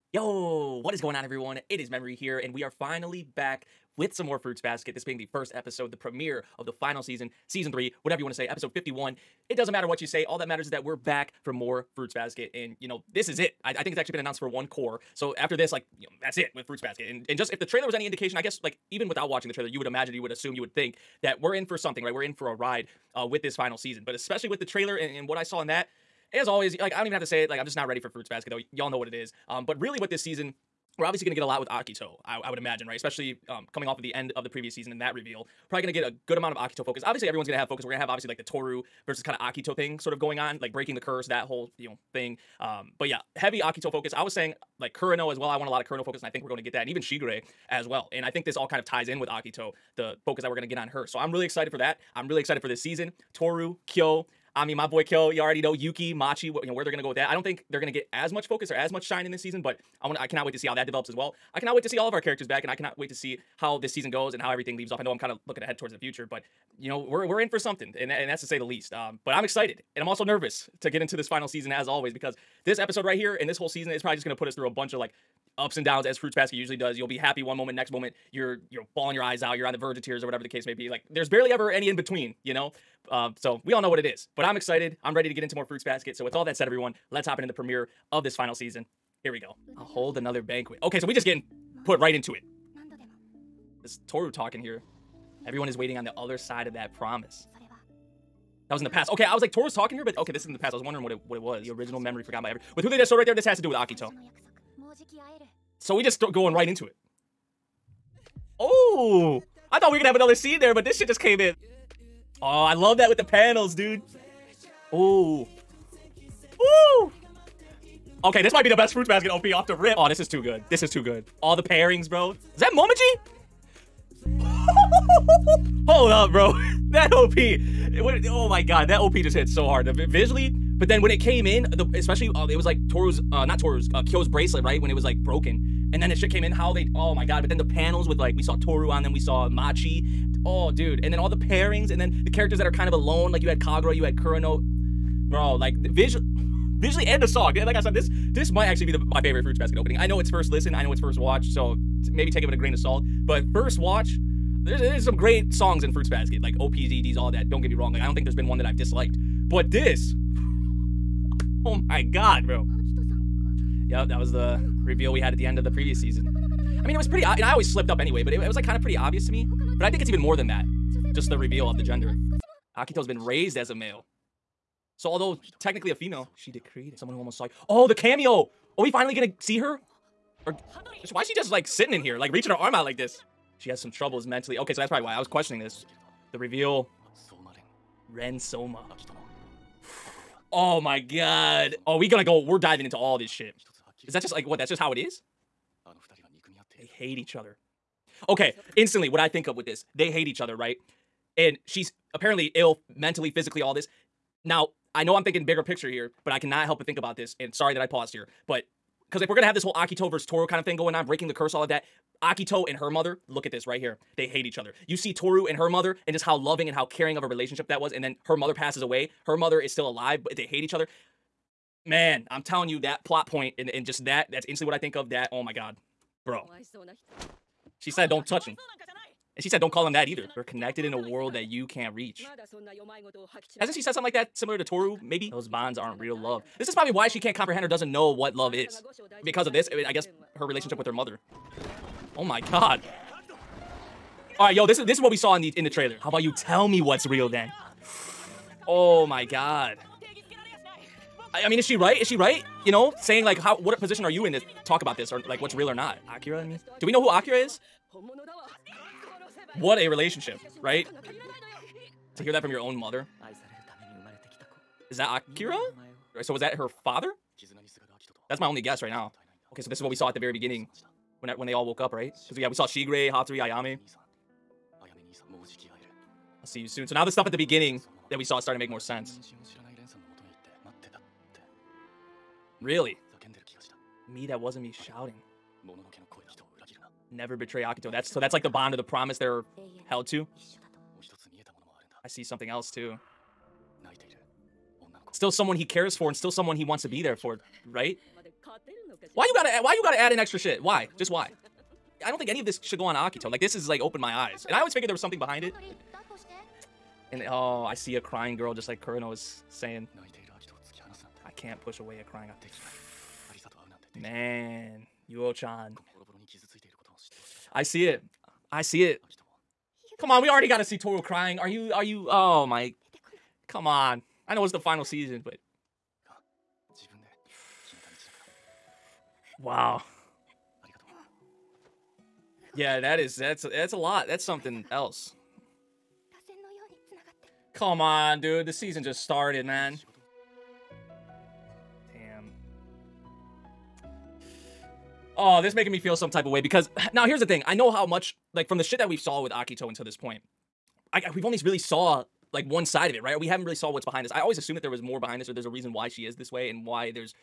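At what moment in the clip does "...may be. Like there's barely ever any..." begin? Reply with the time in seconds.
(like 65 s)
80 s.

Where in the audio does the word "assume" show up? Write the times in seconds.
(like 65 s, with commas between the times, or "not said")
20 s, 354 s.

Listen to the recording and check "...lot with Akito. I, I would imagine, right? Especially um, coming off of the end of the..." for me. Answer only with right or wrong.
right.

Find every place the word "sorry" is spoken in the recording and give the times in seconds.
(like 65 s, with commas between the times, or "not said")
207 s.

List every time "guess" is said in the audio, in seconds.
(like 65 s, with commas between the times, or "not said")
18 s, 239 s, 268 s.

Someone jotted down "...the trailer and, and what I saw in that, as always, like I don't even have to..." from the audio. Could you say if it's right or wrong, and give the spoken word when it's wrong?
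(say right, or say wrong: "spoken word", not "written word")
right.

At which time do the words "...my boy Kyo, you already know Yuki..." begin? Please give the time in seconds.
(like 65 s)
54 s.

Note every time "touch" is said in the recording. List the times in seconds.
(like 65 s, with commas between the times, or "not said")
228 s.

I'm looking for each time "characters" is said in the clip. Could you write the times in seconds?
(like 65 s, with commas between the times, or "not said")
62 s, 142 s.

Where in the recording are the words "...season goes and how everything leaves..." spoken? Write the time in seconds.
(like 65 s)
63 s.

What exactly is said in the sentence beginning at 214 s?
You see Tohru and her mother, and just how loving and how caring of a relationship that was.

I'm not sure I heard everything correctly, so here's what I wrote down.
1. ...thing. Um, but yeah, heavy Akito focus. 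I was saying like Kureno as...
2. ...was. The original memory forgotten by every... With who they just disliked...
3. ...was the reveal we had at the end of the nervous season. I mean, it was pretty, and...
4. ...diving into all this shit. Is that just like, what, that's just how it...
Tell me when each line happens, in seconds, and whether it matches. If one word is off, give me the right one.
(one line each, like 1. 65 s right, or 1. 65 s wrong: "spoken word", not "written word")
1. 42 s right
2. 101 s wrong: "showed", not "disliked"
3. 164 s wrong: "previous", not "nervous"
4. 192 s right.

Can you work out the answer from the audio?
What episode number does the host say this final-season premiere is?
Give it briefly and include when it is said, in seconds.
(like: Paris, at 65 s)
51, at 8 s.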